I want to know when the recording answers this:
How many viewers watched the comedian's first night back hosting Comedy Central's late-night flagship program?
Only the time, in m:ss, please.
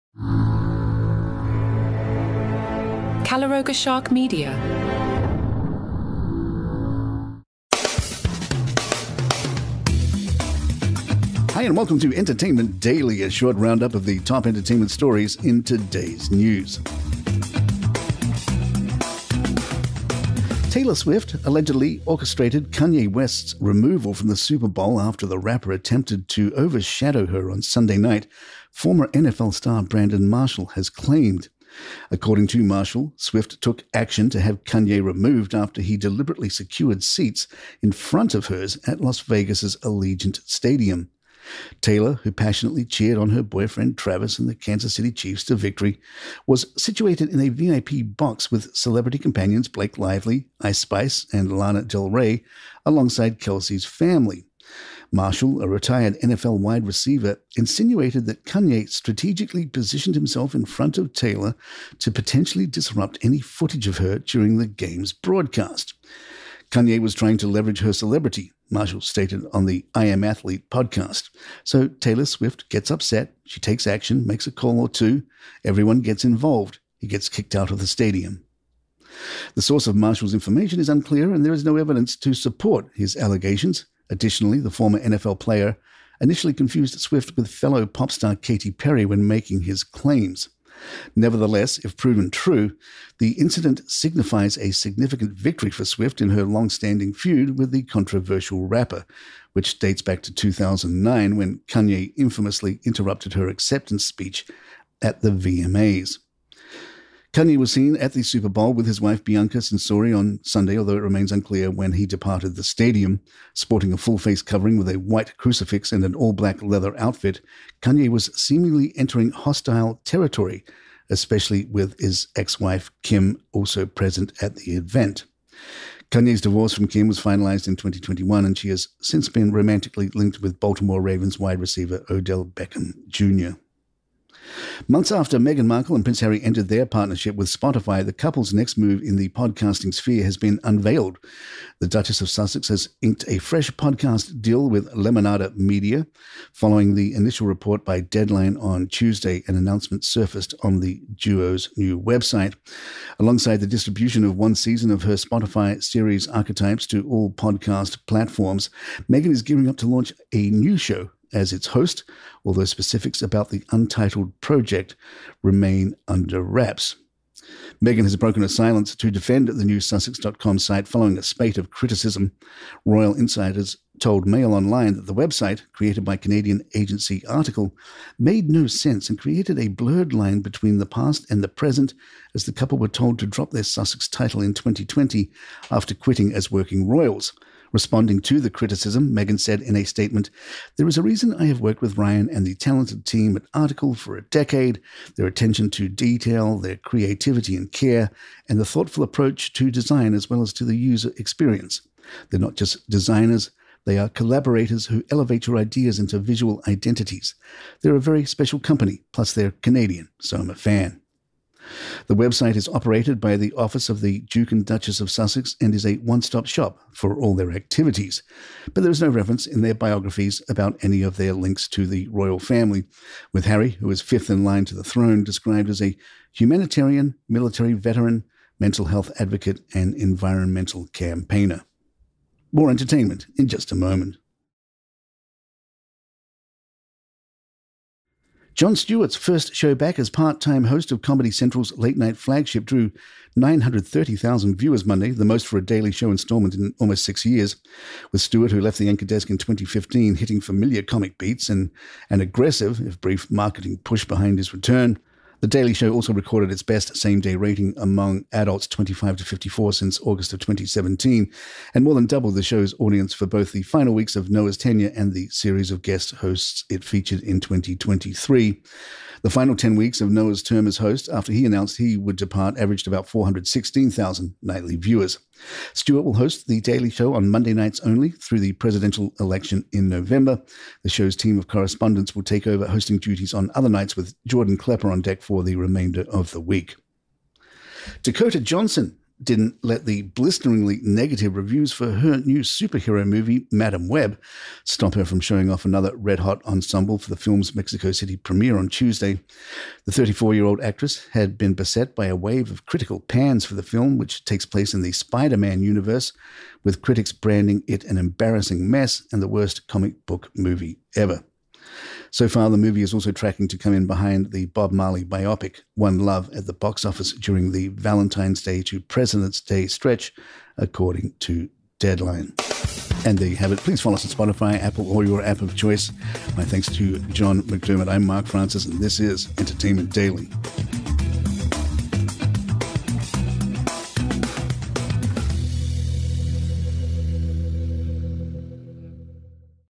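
4:03.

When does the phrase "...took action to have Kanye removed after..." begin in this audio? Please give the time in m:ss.
0:33.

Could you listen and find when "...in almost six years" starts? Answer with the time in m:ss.
4:06.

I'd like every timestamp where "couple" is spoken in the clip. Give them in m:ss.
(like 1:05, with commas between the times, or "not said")
2:18, 3:02.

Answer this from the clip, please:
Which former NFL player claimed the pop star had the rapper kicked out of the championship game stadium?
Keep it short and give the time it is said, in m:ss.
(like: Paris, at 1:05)
Brandon Marshall, at 0:29.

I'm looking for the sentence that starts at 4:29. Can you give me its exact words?
The final 10 weeks of Noah's term as host, after he announced he would depart, averaged about 416,000 nightly viewers.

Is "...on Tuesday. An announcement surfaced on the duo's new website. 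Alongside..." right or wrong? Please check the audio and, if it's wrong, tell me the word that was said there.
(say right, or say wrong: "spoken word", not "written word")
right.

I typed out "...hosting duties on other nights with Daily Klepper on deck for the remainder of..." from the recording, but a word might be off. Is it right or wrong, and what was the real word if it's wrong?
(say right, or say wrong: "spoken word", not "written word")
wrong: "Jordan", not "Daily".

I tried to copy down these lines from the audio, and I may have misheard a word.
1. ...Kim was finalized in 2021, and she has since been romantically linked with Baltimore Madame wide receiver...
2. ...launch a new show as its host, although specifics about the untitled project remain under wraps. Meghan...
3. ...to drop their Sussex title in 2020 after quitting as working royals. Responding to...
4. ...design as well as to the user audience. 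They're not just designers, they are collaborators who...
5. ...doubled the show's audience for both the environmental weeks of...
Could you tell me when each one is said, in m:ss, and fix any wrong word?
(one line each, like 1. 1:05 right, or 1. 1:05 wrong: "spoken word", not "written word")
1. 2:06 wrong: "Ravens", not "Madame"
2. 2:39 right
3. 3:03 right
4. 3:19 wrong: "experience", not "audience"
5. 4:22 wrong: "final", not "environmental".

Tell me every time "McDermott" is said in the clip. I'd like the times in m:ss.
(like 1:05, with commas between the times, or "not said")
5:27.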